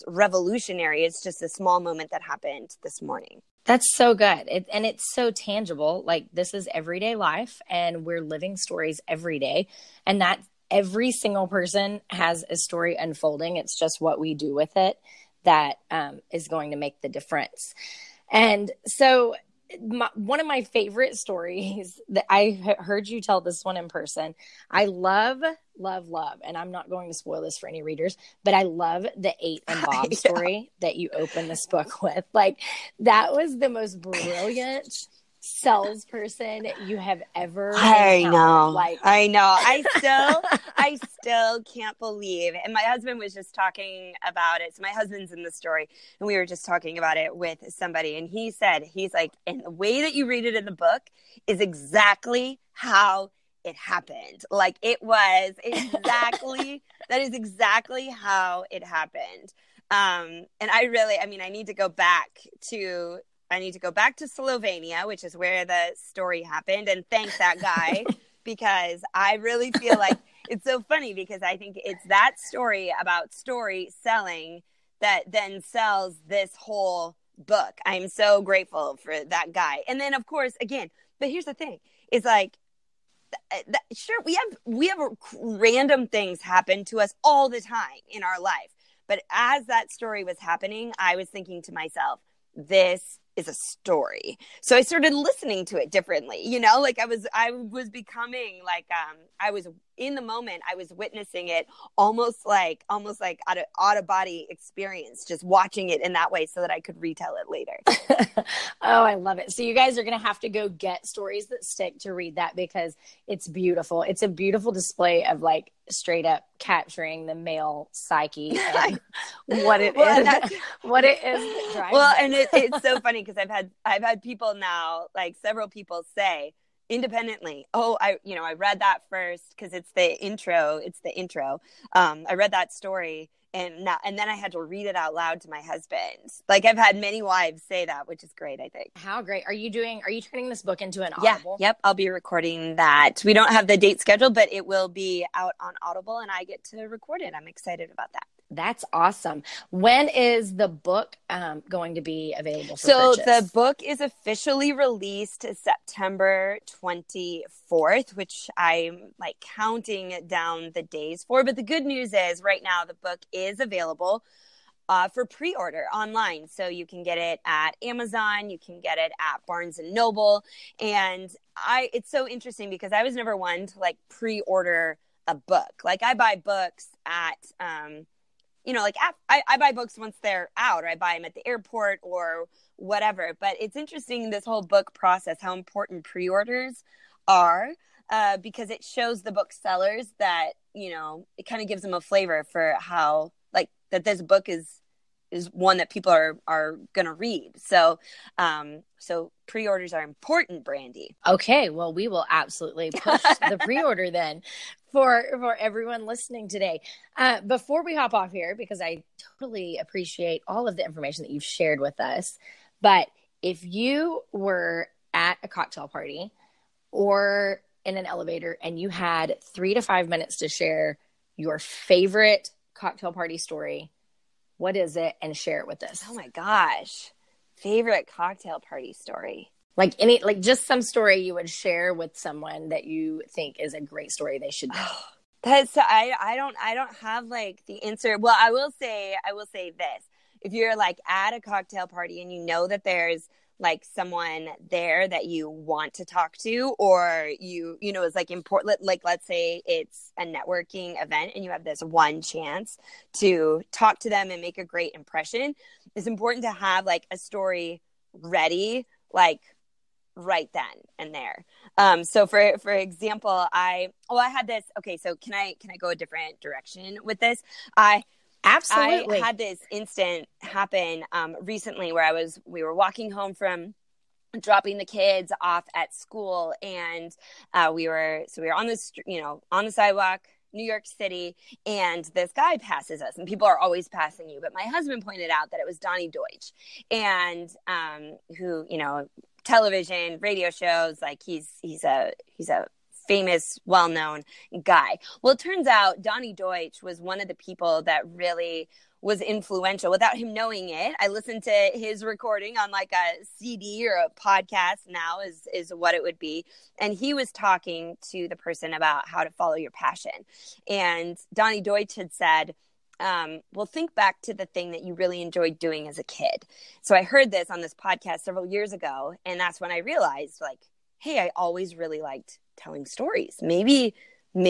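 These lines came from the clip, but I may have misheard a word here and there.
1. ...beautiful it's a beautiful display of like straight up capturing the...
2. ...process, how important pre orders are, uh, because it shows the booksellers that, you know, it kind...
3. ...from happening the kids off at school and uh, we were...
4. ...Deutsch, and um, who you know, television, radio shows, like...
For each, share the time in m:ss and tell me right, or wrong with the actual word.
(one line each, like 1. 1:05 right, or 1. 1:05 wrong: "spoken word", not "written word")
1. 1:53 right
2. 3:04 right
3. 4:33 wrong: "dropping", not "happening"
4. 4:46 right.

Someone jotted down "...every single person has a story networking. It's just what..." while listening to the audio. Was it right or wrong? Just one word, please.
wrong.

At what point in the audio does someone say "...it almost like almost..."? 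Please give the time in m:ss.
1:41.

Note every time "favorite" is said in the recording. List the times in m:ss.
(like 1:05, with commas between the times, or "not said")
0:20, 3:41, 3:47.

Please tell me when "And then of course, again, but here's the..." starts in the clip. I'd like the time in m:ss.
1:19.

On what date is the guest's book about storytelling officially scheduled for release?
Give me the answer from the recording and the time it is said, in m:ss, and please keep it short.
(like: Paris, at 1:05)
September 24, at 2:35.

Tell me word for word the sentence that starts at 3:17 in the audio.
So, um, so pre-orders are important, Brandi.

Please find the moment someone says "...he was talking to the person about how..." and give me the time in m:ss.
5:06.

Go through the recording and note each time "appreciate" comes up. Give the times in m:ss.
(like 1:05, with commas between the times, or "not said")
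3:29.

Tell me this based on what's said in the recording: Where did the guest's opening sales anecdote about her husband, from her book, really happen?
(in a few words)
Slovenia.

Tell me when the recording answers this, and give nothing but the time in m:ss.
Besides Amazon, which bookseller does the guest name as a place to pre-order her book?
2:49.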